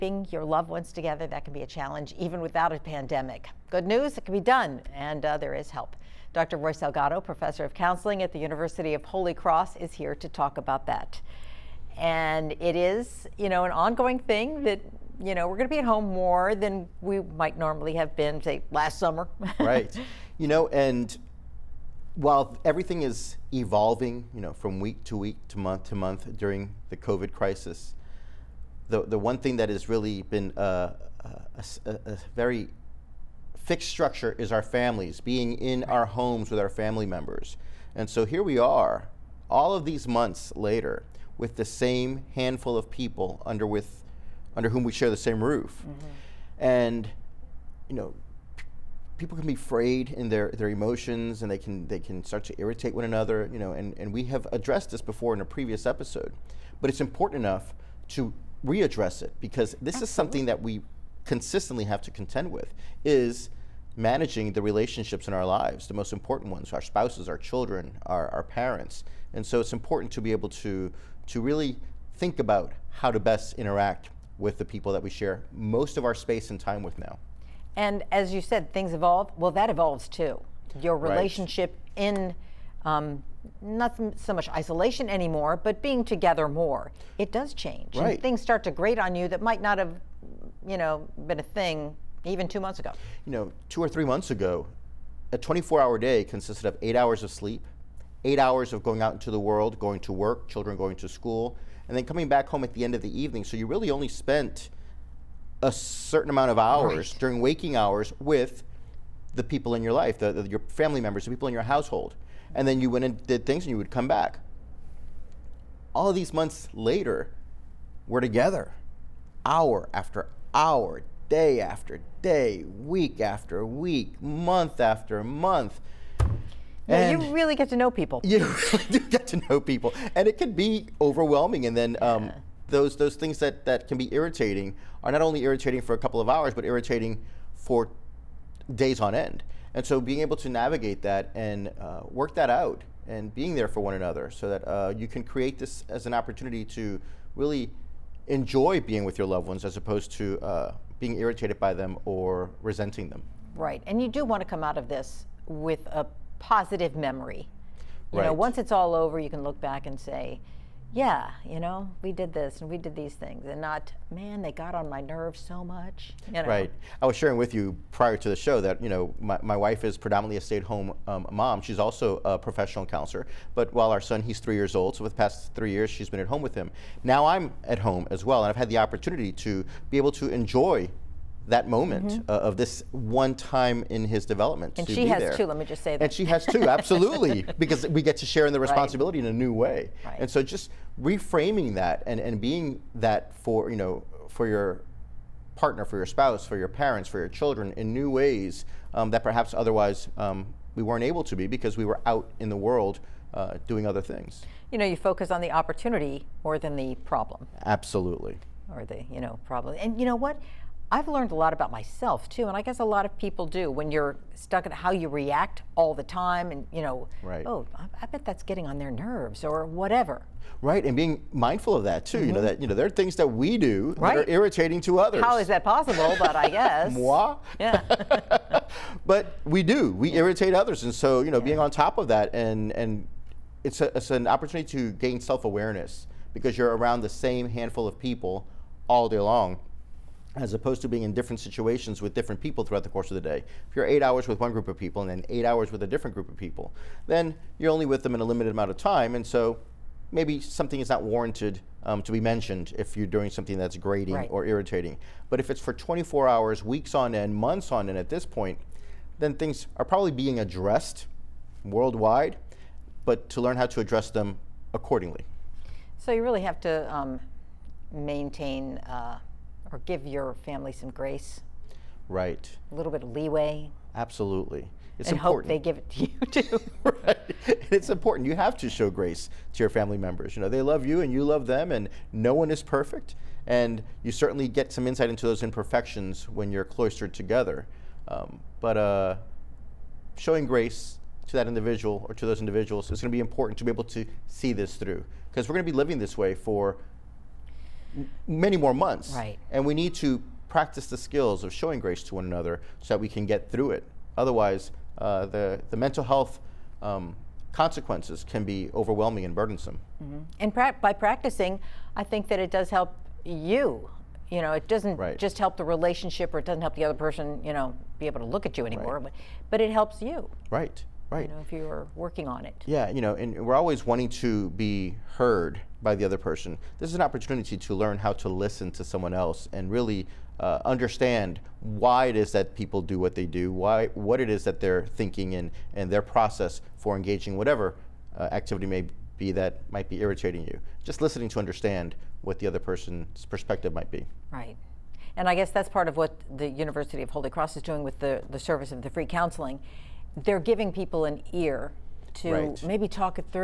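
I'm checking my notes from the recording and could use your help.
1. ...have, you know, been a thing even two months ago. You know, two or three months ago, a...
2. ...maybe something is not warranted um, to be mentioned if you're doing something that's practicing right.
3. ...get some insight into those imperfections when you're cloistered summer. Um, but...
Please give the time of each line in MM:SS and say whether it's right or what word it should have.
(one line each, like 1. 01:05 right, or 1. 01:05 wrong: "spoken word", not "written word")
1. 01:29 right
2. 04:10 wrong: "grating", not "practicing"
3. 04:44 wrong: "together", not "summer".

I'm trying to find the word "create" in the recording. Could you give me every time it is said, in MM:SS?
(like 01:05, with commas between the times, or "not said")
02:25.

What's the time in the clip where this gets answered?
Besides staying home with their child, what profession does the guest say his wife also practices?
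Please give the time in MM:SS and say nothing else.
02:52.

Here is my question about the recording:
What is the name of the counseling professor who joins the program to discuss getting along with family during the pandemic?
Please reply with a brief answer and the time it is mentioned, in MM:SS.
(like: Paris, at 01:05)
Roy Salgado, at 00:06.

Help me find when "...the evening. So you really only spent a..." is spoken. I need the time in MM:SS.
01:43.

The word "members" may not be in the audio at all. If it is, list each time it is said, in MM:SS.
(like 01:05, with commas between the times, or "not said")
00:37, 01:51, 04:39.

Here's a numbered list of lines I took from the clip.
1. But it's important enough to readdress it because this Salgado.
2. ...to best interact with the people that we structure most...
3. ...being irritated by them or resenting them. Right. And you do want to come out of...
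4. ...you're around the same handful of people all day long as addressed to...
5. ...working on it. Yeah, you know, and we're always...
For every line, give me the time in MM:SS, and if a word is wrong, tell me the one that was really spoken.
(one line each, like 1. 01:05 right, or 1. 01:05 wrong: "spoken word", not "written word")
1. 00:56 wrong: "Absolutely", not "Salgado"
2. 01:13 wrong: "share", not "structure"
3. 02:30 right
4. 03:56 wrong: "opposed", not "addressed"
5. 05:21 right.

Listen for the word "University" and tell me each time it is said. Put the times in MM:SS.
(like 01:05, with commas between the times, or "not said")
00:08, 05:46.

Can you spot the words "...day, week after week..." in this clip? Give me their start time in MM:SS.
02:02.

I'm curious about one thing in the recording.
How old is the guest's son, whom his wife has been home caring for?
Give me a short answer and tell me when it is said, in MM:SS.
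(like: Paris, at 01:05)
3 years old, at 02:54.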